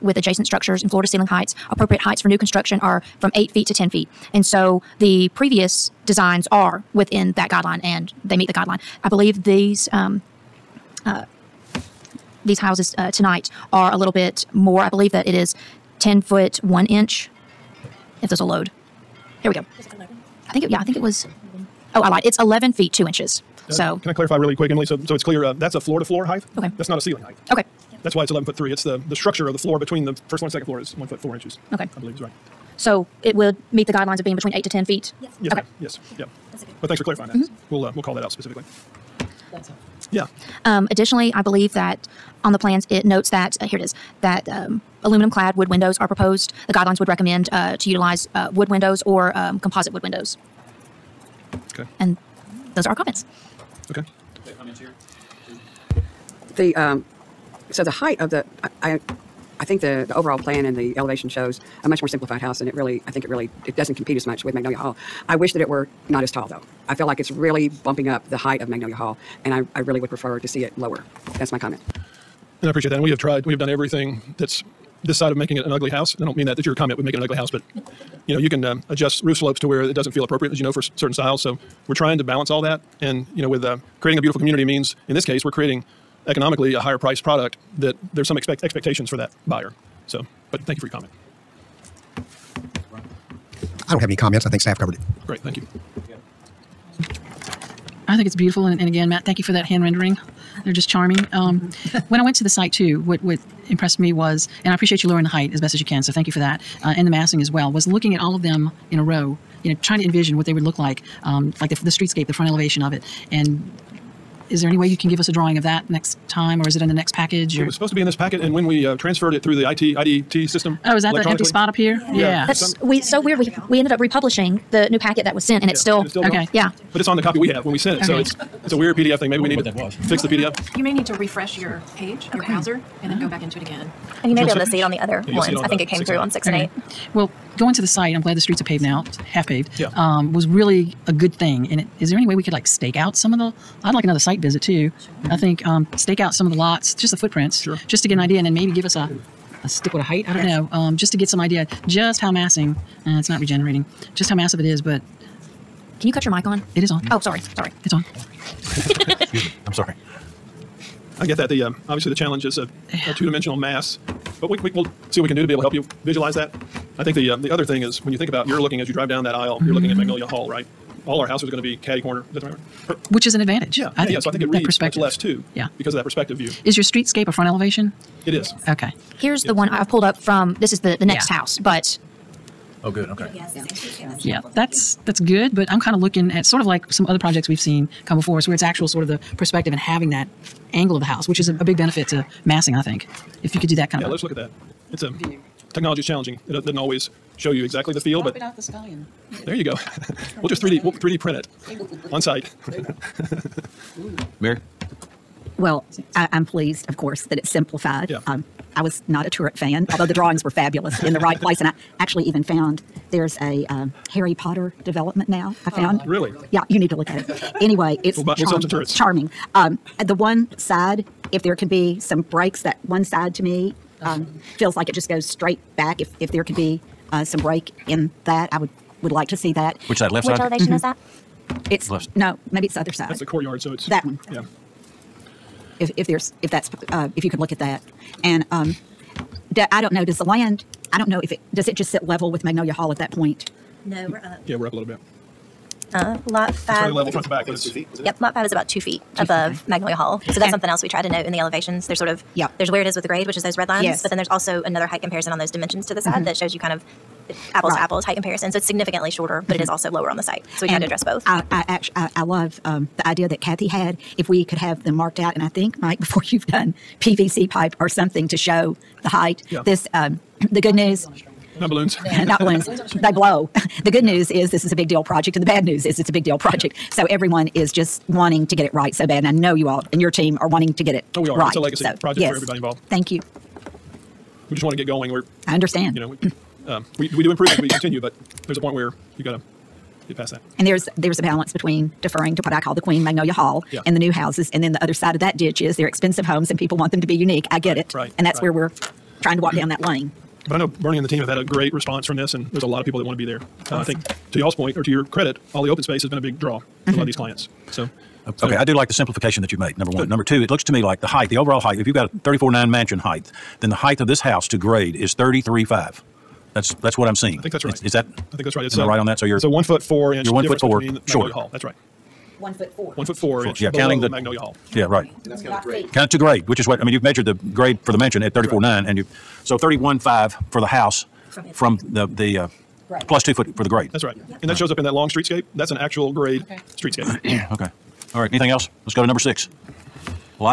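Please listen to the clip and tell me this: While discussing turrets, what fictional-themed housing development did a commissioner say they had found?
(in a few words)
Harry Potter development.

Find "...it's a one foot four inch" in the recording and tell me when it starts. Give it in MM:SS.
05:19.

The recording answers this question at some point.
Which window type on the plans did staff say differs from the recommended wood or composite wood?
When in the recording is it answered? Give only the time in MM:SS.
00:45.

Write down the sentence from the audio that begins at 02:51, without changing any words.
All our houses are going to be catty corner.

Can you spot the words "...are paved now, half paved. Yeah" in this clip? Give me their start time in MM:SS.
02:18.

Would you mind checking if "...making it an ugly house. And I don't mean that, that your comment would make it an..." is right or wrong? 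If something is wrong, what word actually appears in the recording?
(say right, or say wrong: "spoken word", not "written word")
right.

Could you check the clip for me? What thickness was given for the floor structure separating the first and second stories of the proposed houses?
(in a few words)
1 foot 4 inches.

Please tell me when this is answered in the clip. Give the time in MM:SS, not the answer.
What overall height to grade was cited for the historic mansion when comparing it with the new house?
05:12.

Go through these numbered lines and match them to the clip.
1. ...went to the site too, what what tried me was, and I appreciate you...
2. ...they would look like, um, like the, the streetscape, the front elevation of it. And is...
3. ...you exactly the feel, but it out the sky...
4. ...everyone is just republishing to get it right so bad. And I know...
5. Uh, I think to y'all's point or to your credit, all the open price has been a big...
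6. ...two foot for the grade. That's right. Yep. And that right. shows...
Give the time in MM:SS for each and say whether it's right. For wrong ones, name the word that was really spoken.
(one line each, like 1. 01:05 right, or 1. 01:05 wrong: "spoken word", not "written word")
1. 01:42 wrong: "impressed", not "tried"
2. 01:50 right
3. 03:17 right
4. 04:37 wrong: "wanting", not "republishing"
5. 05:03 wrong: "space", not "price"
6. 05:33 right.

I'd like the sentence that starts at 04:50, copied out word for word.
And there's there's a balance between deferring to what I call the Queen Magnolia Hall yeah.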